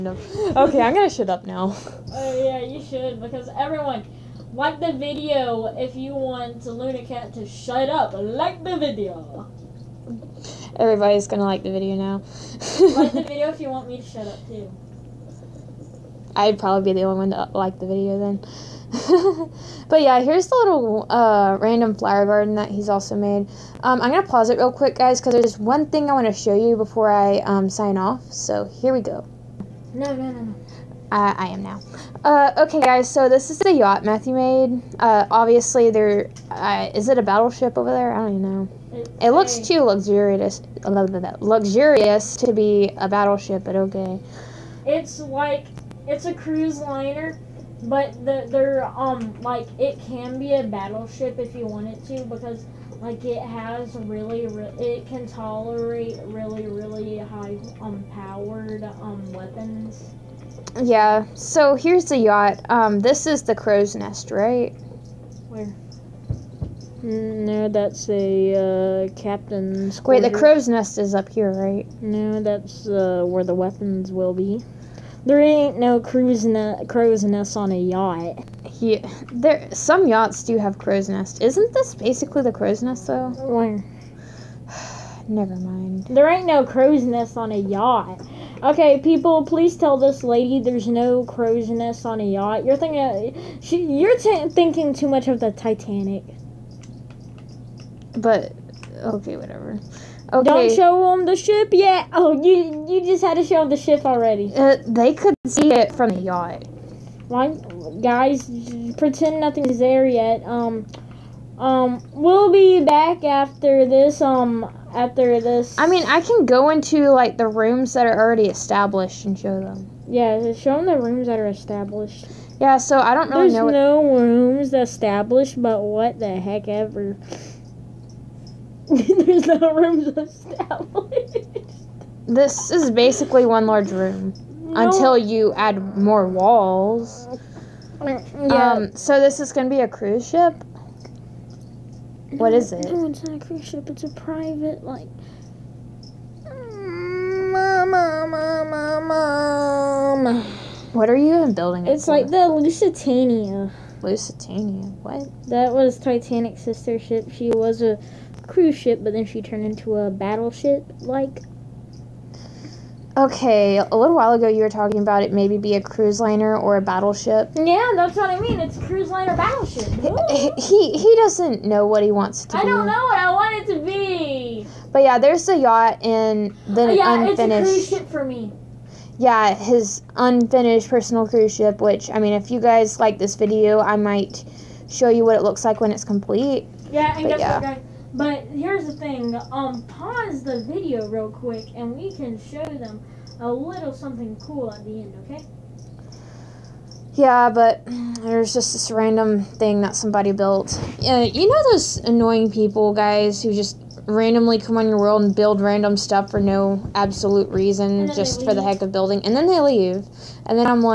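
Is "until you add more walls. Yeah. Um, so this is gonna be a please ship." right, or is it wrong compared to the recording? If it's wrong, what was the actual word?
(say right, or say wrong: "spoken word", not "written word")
wrong: "cruise", not "please".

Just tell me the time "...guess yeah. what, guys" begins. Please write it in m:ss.
3:07.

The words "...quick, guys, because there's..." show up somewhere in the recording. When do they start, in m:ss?
0:24.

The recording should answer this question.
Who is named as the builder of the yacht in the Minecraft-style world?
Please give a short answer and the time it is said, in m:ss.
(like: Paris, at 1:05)
Matthew, at 0:34.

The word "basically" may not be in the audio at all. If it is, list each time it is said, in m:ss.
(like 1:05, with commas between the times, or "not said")
1:21, 2:12.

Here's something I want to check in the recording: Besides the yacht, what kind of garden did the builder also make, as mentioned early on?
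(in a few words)
random flower garden.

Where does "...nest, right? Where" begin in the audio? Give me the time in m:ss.
1:03.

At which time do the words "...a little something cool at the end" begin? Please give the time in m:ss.
3:13.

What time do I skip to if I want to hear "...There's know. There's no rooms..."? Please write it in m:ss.
2:03.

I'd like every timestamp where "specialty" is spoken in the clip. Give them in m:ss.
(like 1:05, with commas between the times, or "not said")
not said.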